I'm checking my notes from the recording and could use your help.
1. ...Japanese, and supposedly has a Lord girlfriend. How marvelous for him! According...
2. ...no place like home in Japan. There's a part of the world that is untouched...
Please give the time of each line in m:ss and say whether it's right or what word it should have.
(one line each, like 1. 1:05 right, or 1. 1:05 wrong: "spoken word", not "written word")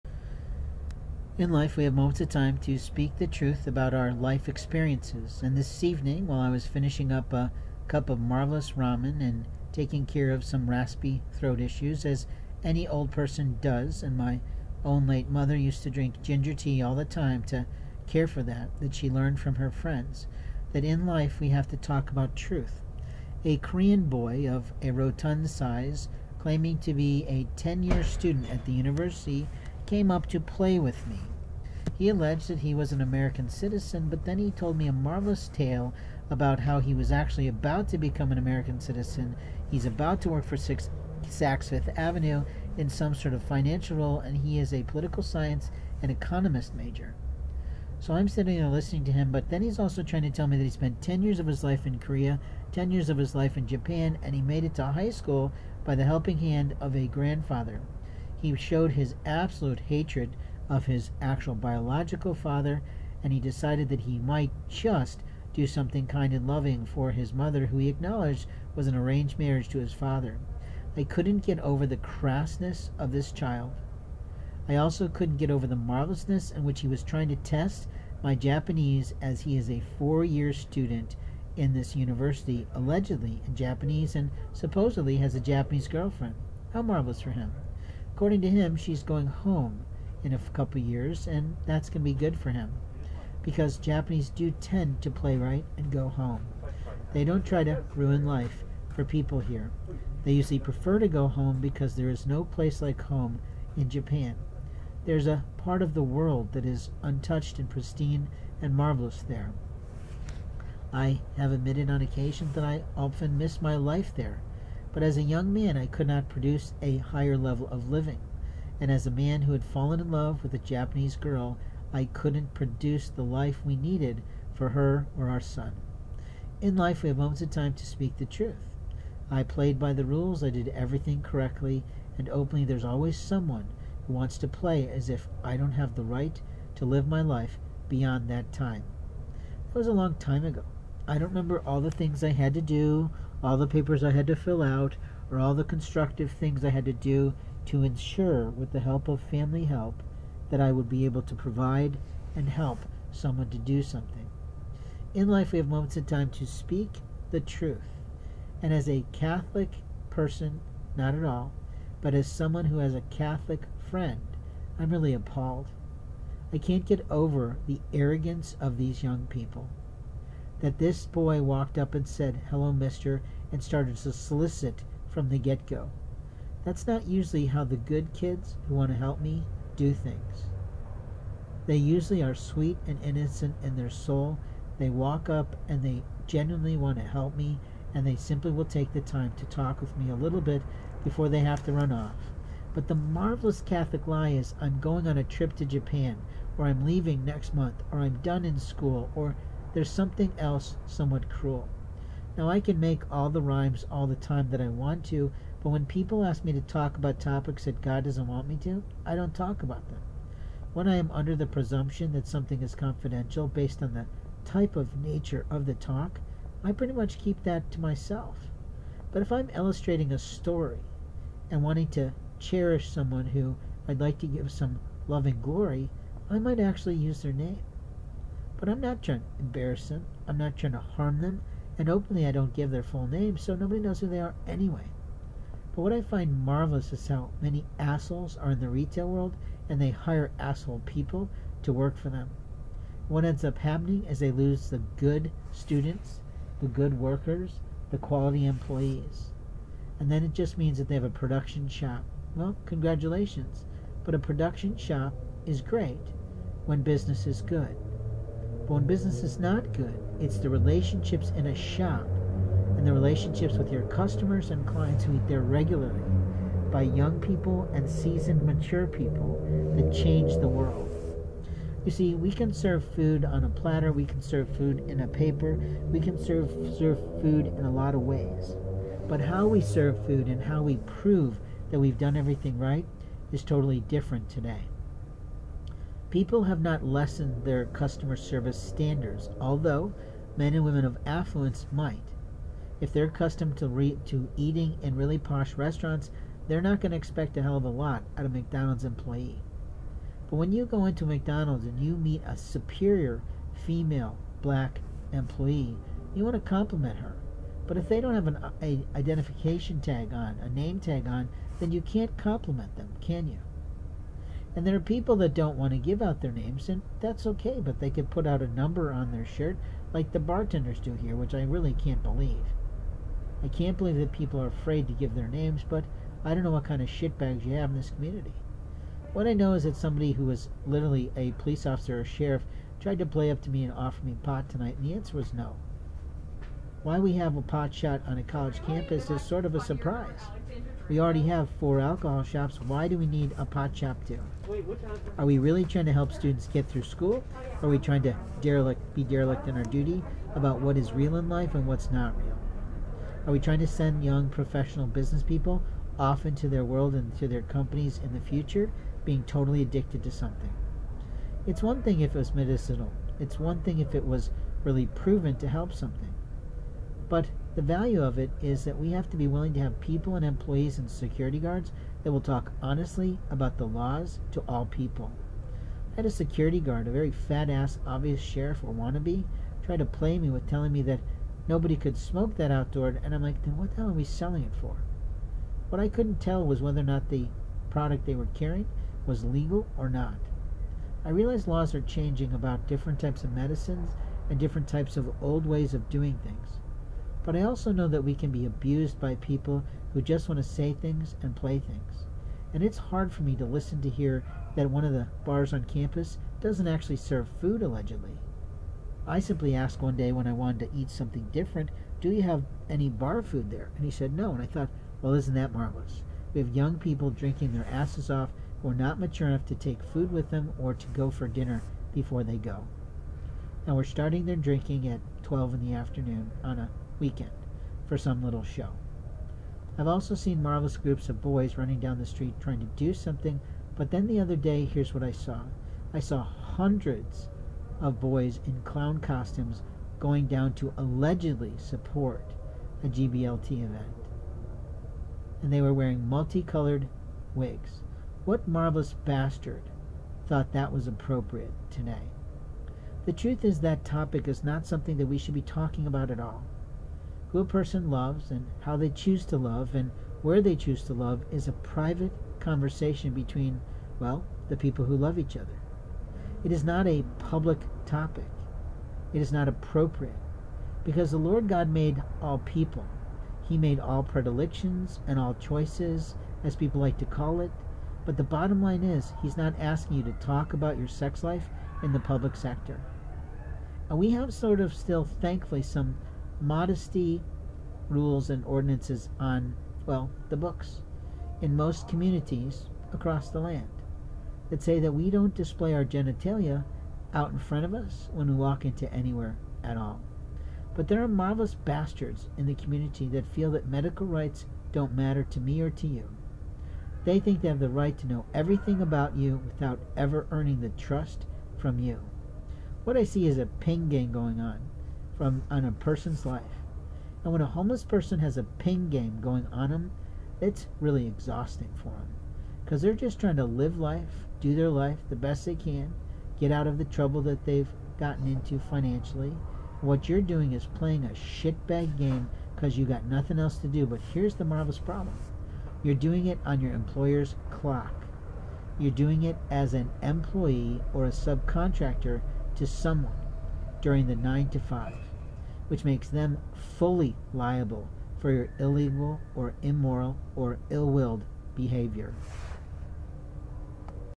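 1. 1:23 wrong: "Japanese", not "Lord"
2. 1:42 right.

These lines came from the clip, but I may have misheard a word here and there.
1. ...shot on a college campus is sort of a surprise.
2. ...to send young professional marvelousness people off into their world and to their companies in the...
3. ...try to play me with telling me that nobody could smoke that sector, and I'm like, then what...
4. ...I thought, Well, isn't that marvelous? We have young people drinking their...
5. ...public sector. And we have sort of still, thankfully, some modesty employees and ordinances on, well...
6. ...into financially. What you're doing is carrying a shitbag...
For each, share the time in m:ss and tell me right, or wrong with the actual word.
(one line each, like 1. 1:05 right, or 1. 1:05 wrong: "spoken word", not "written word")
1. 5:37 right
2. 5:53 wrong: "business", not "marvelousness"
3. 6:19 wrong: "outdoor", not "sector"
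4. 6:54 right
5. 8:01 wrong: "rules", not "employees"
6. 8:48 wrong: "playing", not "carrying".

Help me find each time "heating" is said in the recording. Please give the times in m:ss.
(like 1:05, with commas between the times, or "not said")
not said.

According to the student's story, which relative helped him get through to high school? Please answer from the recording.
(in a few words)
grandfather.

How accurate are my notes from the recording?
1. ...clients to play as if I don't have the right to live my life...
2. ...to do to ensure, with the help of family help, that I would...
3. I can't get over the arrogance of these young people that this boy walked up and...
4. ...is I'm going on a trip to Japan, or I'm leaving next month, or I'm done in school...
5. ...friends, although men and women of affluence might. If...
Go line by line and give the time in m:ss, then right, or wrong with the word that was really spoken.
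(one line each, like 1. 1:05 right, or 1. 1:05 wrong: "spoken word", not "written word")
1. 2:14 wrong: "wants", not "clients"
2. 2:26 right
3. 2:46 right
4. 3:14 right
5. 4:48 wrong: "standards", not "friends".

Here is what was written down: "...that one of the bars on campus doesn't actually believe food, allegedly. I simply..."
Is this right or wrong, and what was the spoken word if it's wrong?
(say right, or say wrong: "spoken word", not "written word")
wrong: "serve", not "believe".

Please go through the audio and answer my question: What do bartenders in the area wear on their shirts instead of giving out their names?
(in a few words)
a number.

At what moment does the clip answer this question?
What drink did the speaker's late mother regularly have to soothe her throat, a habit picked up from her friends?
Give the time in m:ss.
0:16.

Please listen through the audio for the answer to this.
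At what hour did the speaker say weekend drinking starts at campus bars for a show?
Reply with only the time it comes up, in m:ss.
7:05.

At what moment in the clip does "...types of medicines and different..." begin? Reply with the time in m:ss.
6:33.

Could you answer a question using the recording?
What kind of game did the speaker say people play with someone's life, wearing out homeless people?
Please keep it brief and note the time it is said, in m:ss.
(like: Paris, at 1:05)
ping game, at 8:38.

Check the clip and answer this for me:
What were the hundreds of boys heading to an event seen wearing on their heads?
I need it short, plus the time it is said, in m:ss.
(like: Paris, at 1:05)
multicolored wigs, at 7:26.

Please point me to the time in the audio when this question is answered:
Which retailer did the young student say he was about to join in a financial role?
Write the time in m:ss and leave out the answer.
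0:41.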